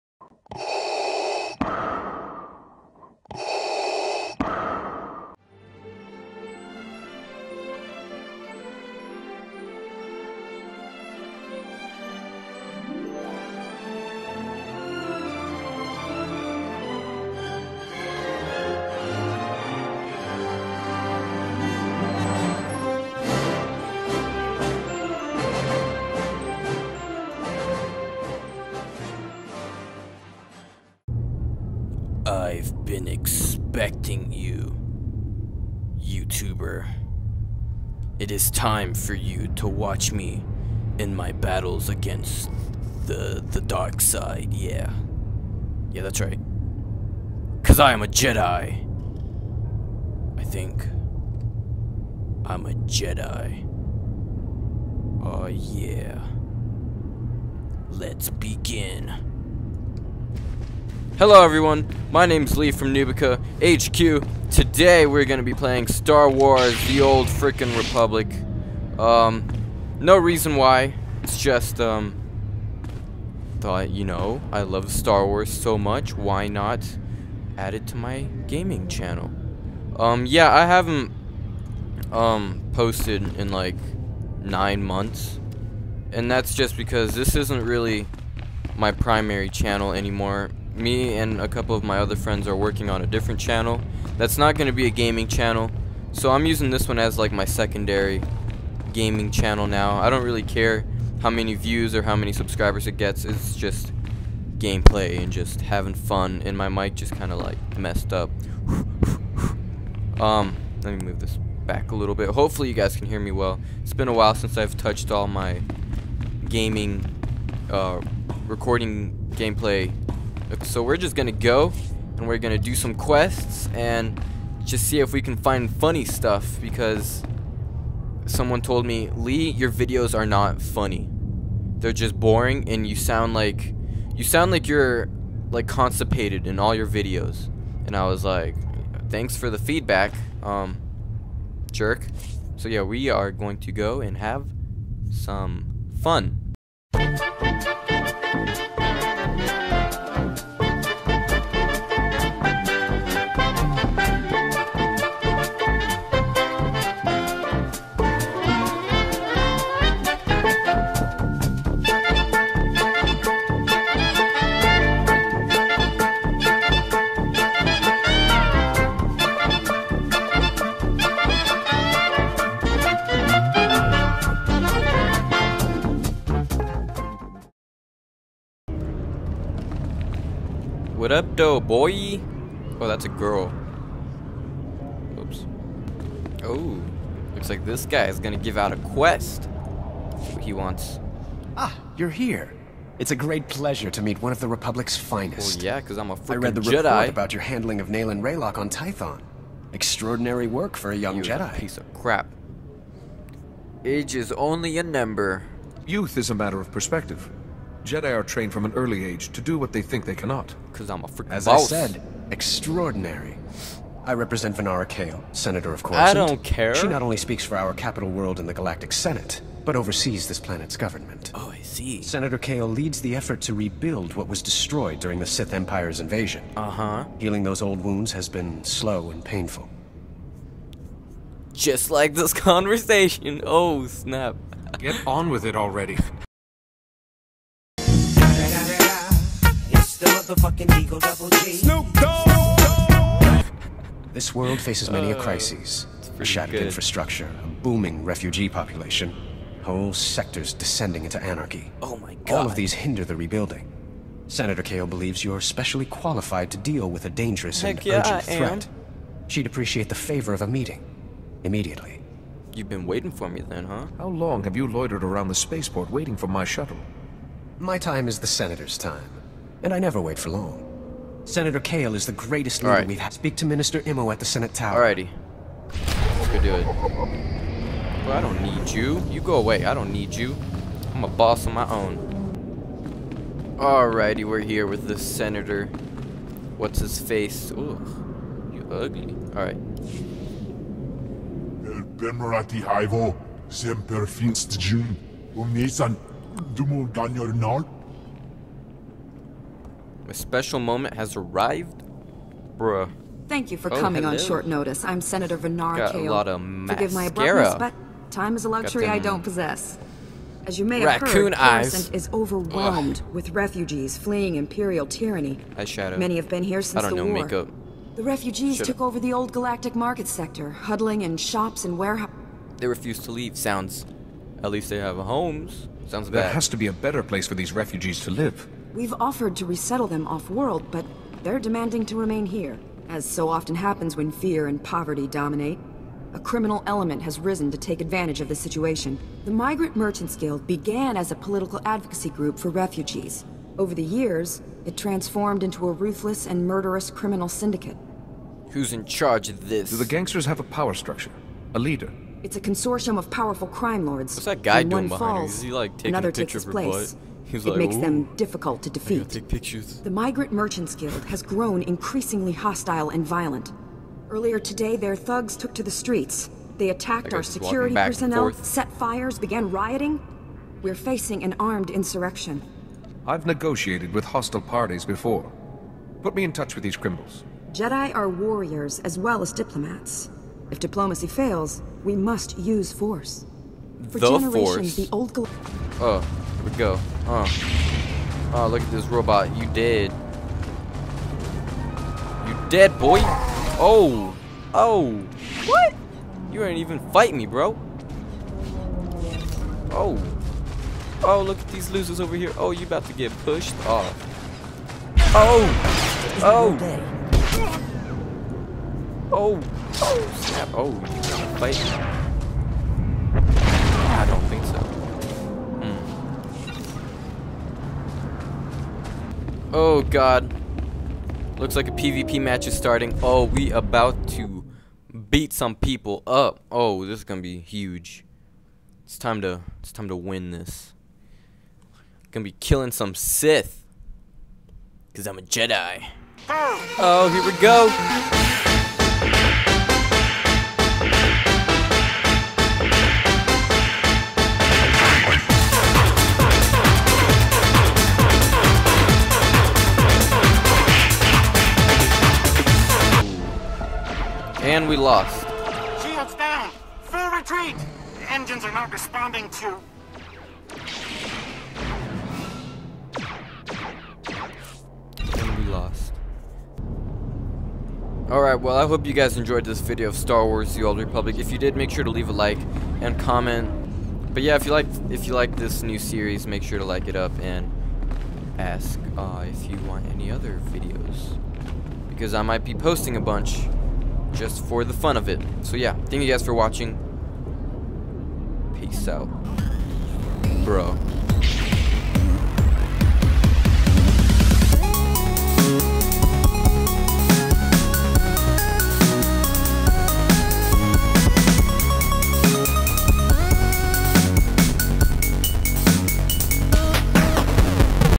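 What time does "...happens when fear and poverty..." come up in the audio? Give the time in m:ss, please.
5:33.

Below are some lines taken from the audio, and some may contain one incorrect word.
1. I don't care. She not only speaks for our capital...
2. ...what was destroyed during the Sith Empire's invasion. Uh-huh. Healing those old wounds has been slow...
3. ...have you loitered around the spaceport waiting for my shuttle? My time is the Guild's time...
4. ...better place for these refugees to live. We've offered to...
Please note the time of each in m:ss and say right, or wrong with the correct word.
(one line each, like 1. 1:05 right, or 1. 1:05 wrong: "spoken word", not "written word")
1. 3:35 right
2. 3:44 right
3. 4:24 wrong: "Senator", not "Guild"
4. 5:26 right.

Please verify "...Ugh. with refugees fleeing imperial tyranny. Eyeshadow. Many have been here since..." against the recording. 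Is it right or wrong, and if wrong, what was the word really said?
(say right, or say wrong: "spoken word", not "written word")
right.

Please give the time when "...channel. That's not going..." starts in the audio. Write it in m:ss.
1:33.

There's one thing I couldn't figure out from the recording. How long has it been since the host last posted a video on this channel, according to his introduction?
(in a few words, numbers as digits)
9 months.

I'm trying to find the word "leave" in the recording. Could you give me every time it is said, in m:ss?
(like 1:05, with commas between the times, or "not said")
5:23, 7:51.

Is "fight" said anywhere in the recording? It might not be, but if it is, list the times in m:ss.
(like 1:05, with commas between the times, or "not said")
6:36, 6:51.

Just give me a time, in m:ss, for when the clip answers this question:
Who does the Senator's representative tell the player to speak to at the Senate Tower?
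4:33.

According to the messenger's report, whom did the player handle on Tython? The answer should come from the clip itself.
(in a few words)
Naylan Raylock.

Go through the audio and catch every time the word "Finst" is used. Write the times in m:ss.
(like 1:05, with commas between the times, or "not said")
4:54.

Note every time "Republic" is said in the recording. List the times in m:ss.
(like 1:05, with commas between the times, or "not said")
1:07, 3:14, 7:50.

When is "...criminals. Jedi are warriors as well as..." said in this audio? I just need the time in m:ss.
6:16.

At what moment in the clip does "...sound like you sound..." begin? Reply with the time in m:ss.
2:12.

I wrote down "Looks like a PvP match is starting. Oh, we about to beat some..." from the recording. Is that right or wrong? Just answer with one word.
right.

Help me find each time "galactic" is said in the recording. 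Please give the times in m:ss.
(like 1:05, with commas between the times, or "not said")
3:38, 5:19.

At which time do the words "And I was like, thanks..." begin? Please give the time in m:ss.
2:17.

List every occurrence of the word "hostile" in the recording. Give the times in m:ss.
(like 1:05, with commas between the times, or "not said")
6:02, 6:14.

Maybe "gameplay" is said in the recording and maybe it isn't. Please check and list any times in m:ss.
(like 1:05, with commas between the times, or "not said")
1:44, 1:59.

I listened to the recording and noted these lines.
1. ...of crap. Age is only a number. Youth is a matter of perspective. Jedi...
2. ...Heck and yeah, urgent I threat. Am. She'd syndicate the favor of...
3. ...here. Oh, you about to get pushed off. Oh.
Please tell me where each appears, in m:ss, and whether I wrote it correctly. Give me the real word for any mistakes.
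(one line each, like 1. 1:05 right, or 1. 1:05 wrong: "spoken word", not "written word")
1. 3:21 right
2. 4:17 wrong: "appreciate", not "syndicate"
3. 6:42 right.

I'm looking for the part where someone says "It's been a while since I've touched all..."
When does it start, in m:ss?
1:53.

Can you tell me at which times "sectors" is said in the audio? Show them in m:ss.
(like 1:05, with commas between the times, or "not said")
4:09, 5:20.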